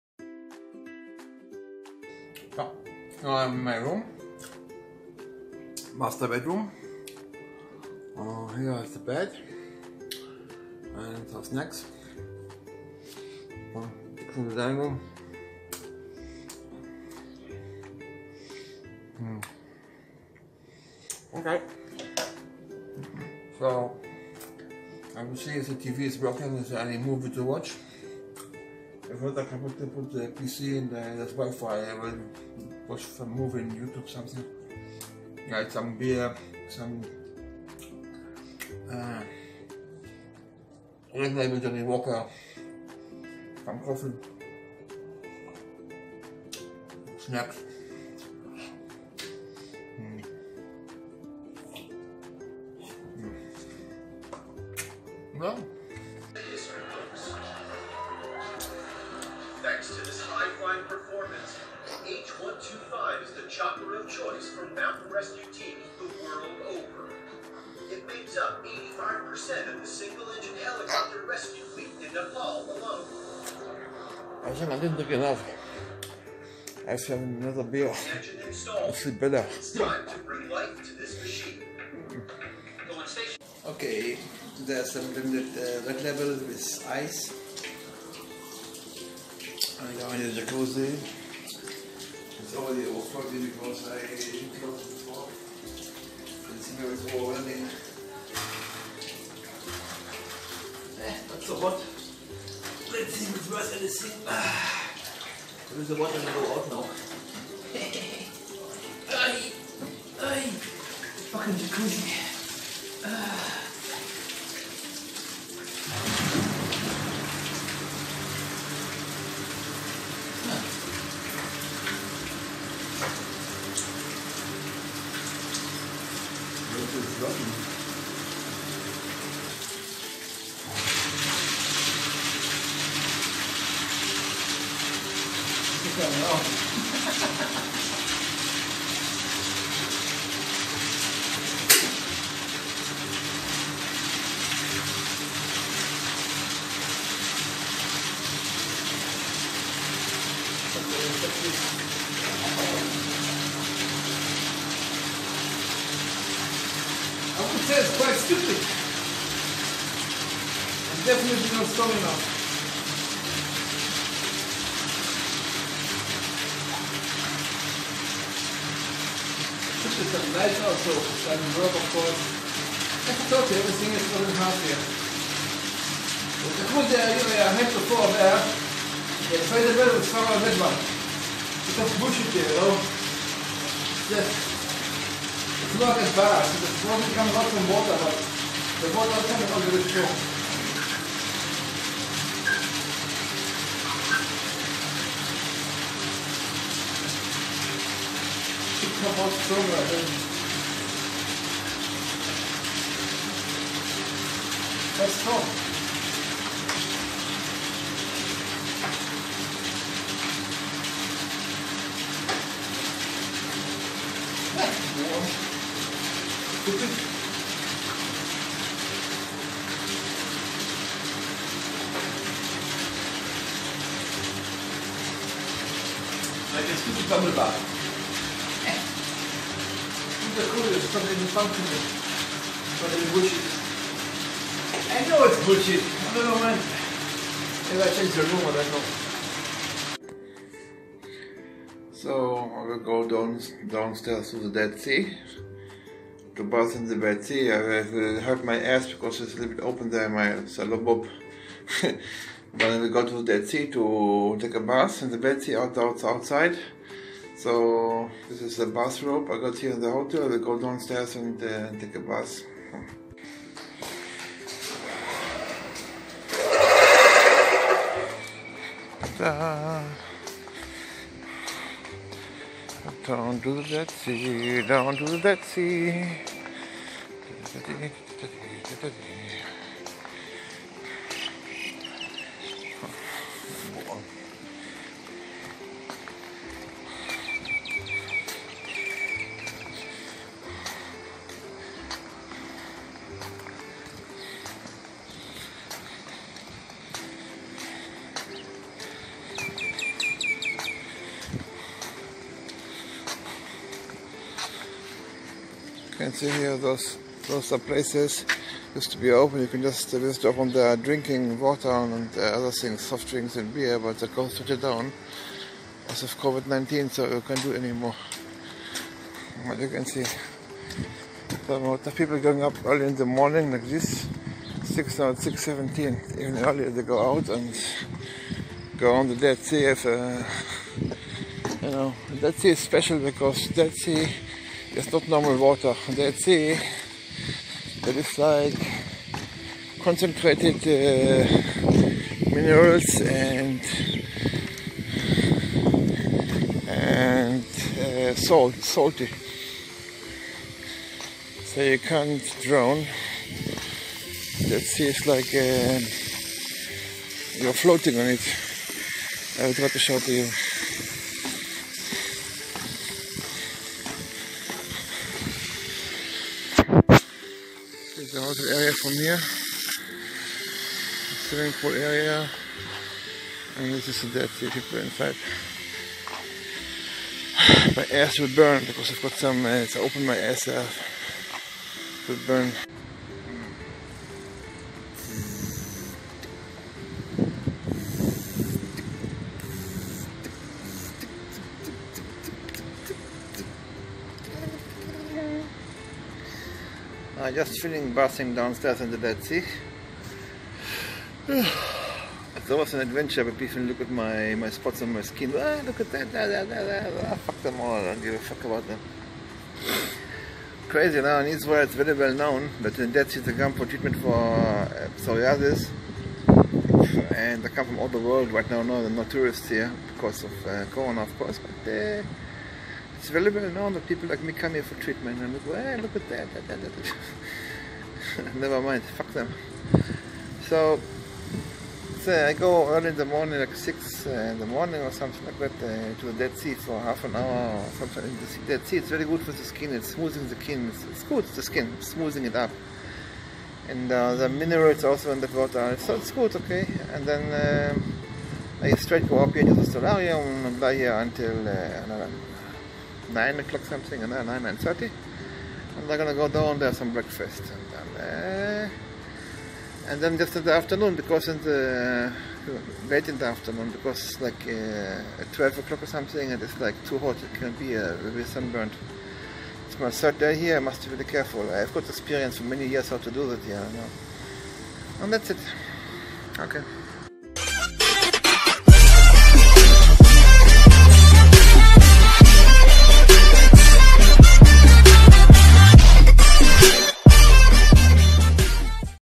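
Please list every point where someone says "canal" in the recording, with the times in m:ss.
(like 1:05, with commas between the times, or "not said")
2:15.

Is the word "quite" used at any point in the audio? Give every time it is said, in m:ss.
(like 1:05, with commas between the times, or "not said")
2:37.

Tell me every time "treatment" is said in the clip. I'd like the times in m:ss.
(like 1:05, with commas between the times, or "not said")
6:53, 7:04.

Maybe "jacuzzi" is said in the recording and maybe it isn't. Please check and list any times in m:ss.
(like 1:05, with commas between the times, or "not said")
1:30, 1:51.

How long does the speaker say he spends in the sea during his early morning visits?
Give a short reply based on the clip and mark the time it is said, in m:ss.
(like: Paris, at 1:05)
half an hour, at 7:16.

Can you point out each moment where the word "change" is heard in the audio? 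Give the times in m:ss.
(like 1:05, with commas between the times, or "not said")
3:57.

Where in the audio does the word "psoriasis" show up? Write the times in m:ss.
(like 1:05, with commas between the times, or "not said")
6:54.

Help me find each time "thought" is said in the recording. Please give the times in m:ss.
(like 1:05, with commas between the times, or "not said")
2:53.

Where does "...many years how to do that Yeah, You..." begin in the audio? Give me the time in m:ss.
7:52.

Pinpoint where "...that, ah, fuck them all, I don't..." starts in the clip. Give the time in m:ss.
6:46.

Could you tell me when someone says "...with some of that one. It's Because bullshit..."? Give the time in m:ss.
2:59.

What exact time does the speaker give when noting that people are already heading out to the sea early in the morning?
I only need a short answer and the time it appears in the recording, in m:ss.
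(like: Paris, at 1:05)
6:17, at 5:25.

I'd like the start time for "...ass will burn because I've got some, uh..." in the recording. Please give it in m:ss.
6:17.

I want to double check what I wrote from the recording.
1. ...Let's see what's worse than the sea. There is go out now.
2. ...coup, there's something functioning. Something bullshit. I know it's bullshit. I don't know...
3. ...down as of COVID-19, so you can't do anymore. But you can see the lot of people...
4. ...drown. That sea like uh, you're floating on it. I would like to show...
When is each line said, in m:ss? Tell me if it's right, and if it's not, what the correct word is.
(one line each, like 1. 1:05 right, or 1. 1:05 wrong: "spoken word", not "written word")
1. 1:41 right
2. 3:50 right
3. 5:14 right
4. 5:52 right.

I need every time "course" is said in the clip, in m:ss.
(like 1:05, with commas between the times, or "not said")
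2:51, 7:01.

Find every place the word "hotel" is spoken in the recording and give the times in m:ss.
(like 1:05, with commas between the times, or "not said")
4:19, 6:08.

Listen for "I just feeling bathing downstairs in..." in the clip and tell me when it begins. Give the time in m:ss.
6:37.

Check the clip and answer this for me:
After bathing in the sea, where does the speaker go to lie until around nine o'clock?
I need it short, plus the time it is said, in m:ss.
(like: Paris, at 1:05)
solarium, at 7:29.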